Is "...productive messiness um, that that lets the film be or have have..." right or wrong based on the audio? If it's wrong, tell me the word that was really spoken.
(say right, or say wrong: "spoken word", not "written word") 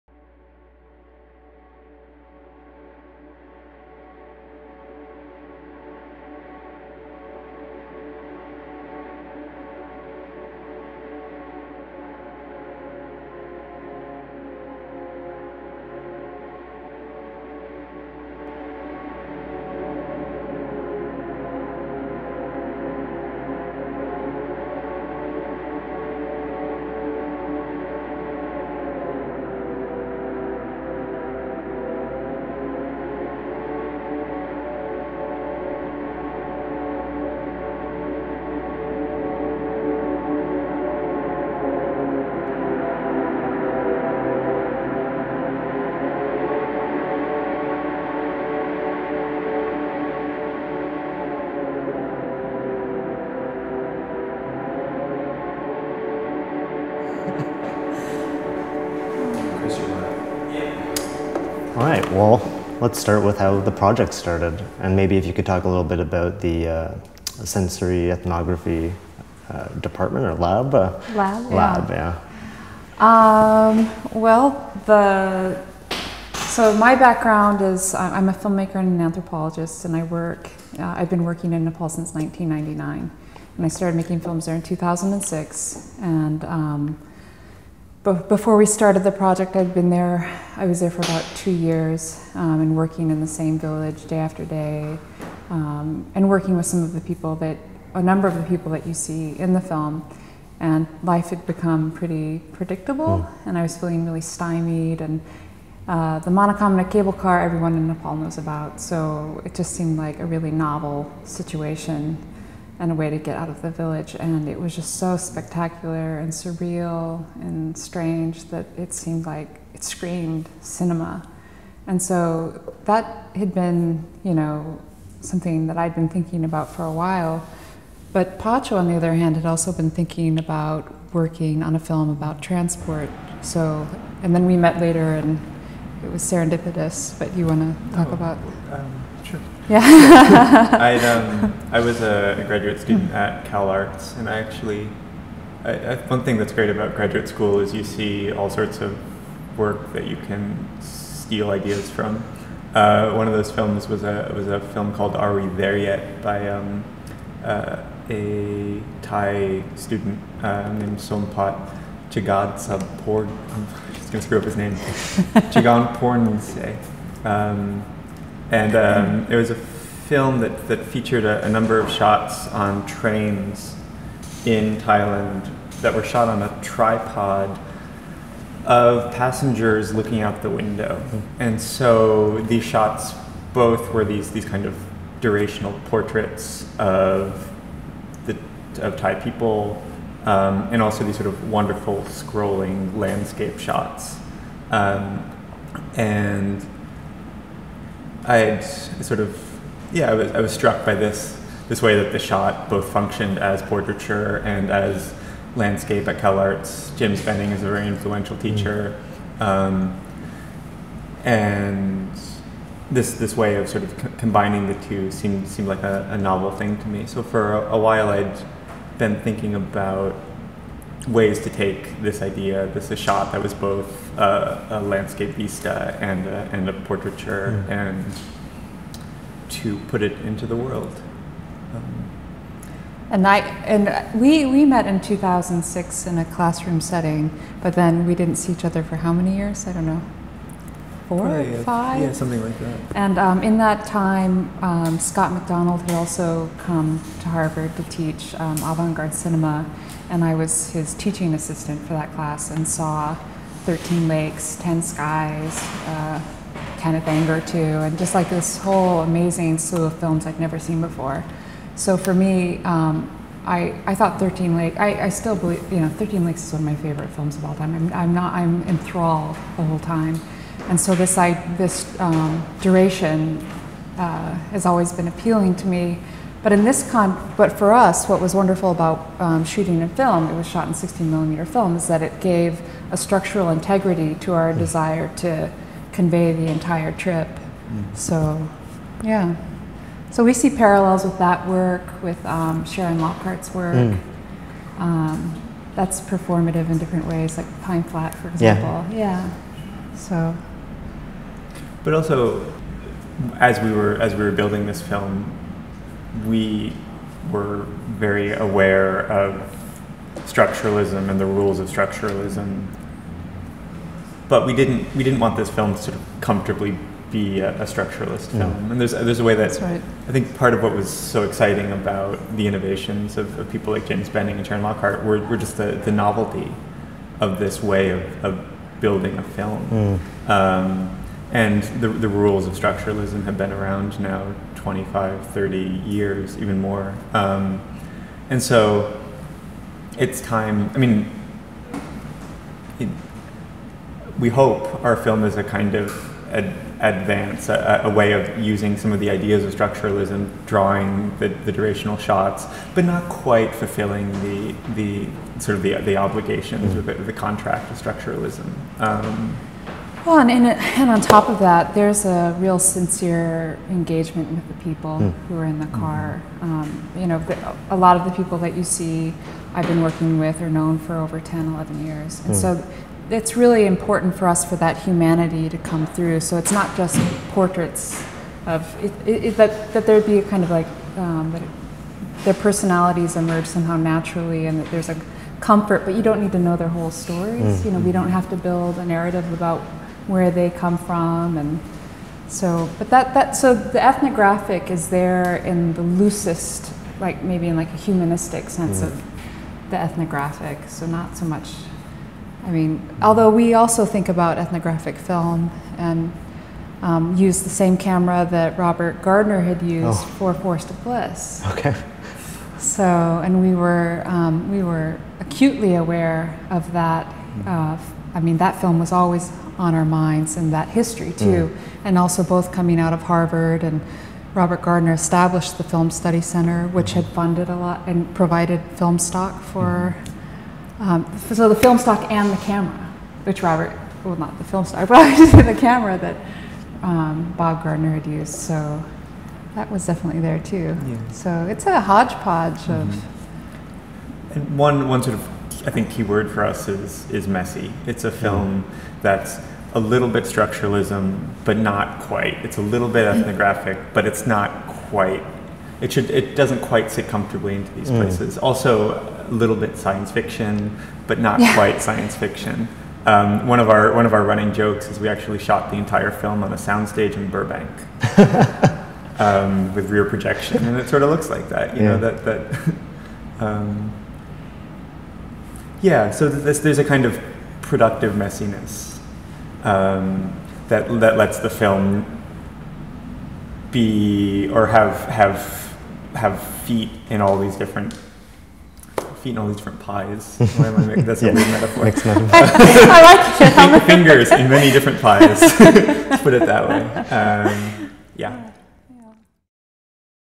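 right.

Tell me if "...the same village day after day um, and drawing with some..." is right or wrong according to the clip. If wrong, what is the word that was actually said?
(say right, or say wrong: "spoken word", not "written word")
wrong: "working", not "drawing".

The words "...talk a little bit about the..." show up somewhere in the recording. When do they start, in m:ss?
1:05.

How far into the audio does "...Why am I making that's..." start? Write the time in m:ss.
8:10.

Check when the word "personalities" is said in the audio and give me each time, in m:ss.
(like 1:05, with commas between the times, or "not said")
6:22.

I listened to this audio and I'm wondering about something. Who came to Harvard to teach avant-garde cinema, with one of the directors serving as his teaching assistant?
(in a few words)
Scott MacDonald.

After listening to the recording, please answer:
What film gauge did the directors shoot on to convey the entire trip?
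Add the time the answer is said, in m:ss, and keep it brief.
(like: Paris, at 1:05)
16 millimeter, at 4:40.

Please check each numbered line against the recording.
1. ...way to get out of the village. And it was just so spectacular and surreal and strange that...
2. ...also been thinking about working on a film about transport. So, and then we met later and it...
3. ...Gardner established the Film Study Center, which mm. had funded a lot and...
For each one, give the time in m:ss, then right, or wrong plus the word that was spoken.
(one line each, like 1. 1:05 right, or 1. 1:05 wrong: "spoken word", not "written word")
1. 1:52 right
2. 2:09 right
3. 7:04 right.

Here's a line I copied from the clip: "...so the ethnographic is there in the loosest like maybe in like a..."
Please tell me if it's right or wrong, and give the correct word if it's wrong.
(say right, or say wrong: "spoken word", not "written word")
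right.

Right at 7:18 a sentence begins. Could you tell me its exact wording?
So that was definitely there too.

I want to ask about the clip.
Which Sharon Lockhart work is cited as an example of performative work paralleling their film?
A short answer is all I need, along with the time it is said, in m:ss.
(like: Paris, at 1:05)
Pine Flat, at 4:57.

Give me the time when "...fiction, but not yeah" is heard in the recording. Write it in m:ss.
7:40.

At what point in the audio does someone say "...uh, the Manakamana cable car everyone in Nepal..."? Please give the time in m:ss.
1:45.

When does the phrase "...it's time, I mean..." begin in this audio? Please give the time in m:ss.
5:39.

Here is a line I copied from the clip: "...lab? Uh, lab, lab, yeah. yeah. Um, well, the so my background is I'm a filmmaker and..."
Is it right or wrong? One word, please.
right.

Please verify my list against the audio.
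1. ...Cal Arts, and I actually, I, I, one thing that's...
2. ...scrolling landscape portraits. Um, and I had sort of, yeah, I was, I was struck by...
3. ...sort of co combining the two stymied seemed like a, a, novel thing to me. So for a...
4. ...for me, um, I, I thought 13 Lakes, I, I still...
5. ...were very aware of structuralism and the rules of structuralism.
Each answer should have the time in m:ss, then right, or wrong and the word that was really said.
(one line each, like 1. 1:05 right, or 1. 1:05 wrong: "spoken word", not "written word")
1. 2:23 right
2. 3:12 wrong: "shots", not "portraits"
3. 3:33 wrong: "seemed", not "stymied"
4. 4:21 right
5. 5:07 right.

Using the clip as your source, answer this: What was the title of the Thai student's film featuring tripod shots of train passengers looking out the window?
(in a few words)
Are We There Yet.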